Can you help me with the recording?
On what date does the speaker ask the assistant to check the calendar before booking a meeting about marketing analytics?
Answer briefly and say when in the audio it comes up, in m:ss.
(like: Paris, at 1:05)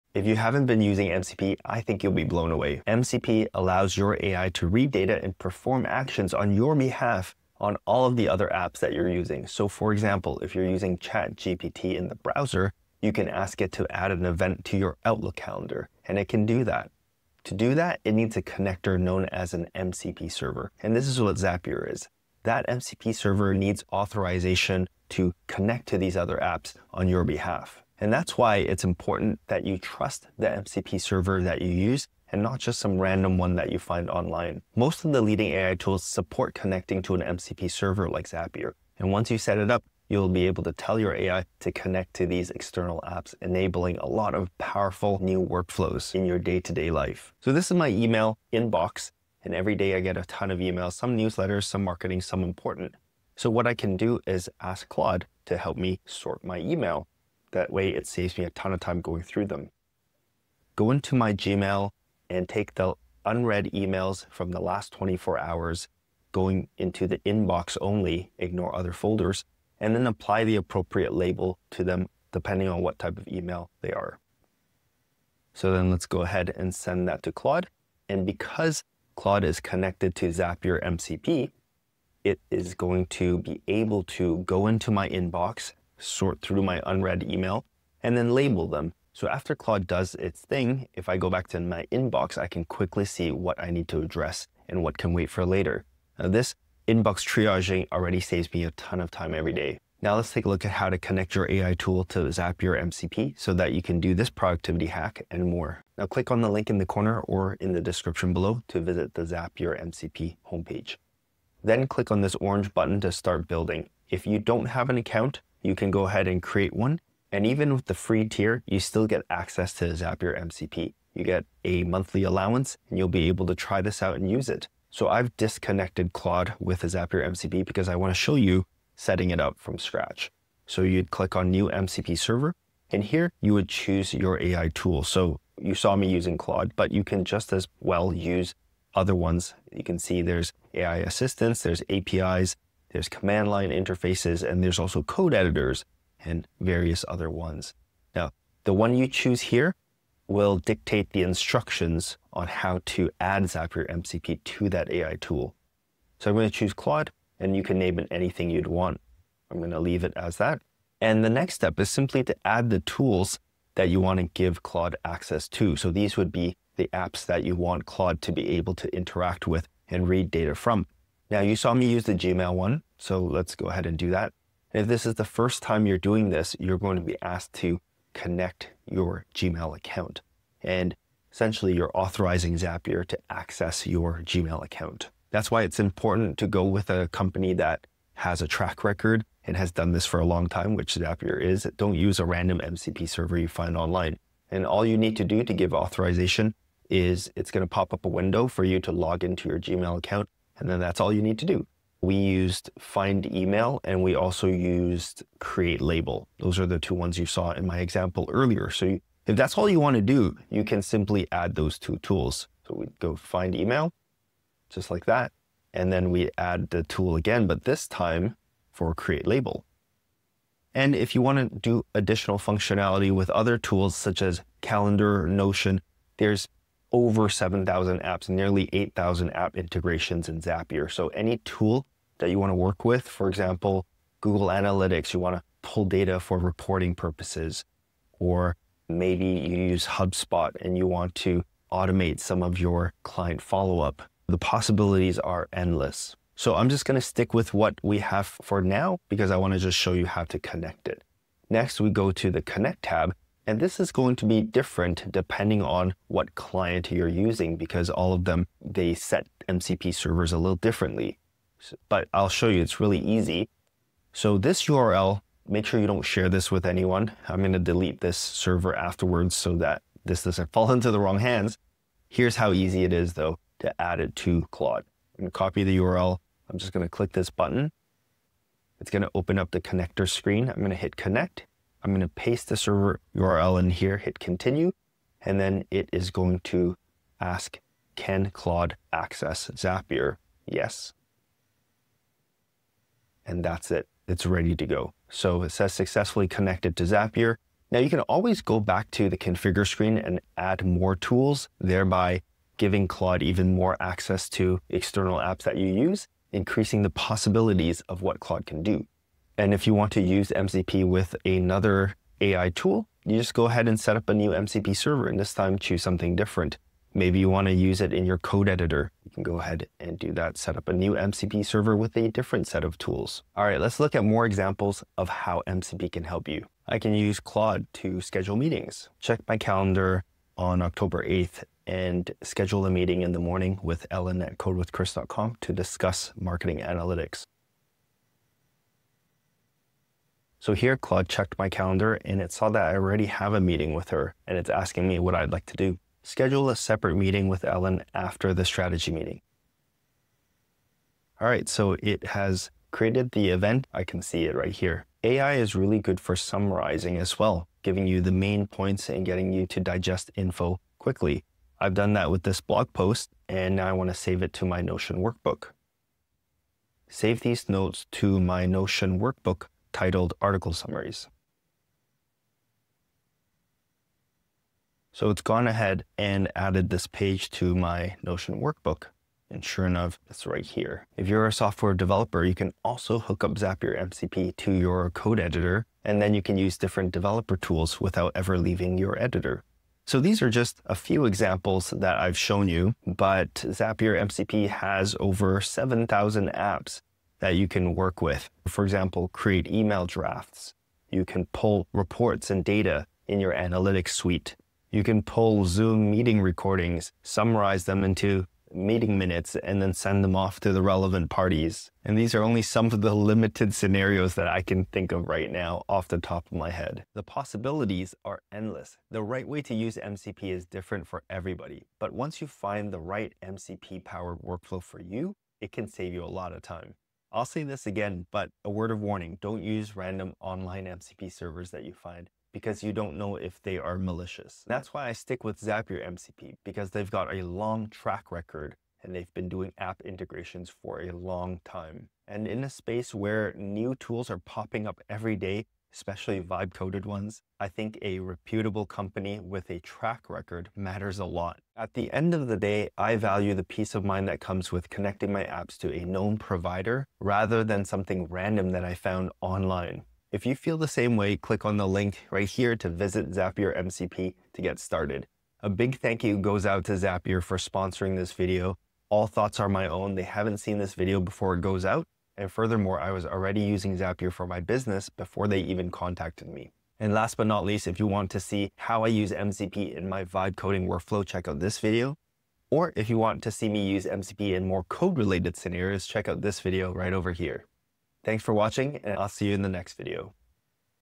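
October 8th, at 5:30.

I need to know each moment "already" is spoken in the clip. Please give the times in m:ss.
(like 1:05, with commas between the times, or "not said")
1:37, 5:42, 7:53.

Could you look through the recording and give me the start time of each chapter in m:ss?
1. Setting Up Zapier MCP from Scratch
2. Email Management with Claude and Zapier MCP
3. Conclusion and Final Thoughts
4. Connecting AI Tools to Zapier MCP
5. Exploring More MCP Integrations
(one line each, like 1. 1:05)
1. 1:39
2. 0:47
3. 6:58
4. 2:04
5. 5:23.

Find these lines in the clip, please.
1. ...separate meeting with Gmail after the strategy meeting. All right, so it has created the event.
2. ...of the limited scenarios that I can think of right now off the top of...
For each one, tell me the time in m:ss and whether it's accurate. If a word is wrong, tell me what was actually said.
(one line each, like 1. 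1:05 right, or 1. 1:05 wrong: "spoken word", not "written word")
1. 5:46 wrong: "Ellen", not "Gmail"
2. 6:52 right.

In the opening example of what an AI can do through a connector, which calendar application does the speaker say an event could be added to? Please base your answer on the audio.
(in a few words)
Outlook.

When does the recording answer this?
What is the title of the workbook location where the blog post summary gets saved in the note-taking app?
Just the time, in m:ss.
6:10.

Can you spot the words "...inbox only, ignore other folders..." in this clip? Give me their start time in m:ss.
1:07.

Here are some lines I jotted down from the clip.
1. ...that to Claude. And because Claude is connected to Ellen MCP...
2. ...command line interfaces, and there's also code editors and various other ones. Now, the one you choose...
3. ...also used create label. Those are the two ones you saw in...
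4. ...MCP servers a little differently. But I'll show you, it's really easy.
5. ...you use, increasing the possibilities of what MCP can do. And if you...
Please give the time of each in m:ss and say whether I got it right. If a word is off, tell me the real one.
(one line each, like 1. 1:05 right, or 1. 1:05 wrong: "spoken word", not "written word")
1. 1:17 wrong: "Zapier", not "Ellen"
2. 2:23 right
3. 3:24 right
4. 4:19 right
5. 5:05 wrong: "Claude", not "MCP".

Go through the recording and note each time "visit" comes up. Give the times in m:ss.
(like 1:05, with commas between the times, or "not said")
1:48, 7:42.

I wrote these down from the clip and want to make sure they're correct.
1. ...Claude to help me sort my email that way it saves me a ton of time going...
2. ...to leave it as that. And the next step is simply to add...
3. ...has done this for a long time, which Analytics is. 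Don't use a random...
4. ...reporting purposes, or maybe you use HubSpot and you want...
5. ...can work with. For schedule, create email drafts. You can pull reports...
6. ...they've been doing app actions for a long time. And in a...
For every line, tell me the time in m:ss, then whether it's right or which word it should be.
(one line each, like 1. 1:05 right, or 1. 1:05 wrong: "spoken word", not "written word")
1. 0:54 right
2. 2:39 right
3. 3:09 wrong: "Zapier", not "Analytics"
4. 3:56 right
5. 6:37 wrong: "example", not "schedule"
6. 7:18 wrong: "integrations", not "actions".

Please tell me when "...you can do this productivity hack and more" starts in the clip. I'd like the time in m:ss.
1:43.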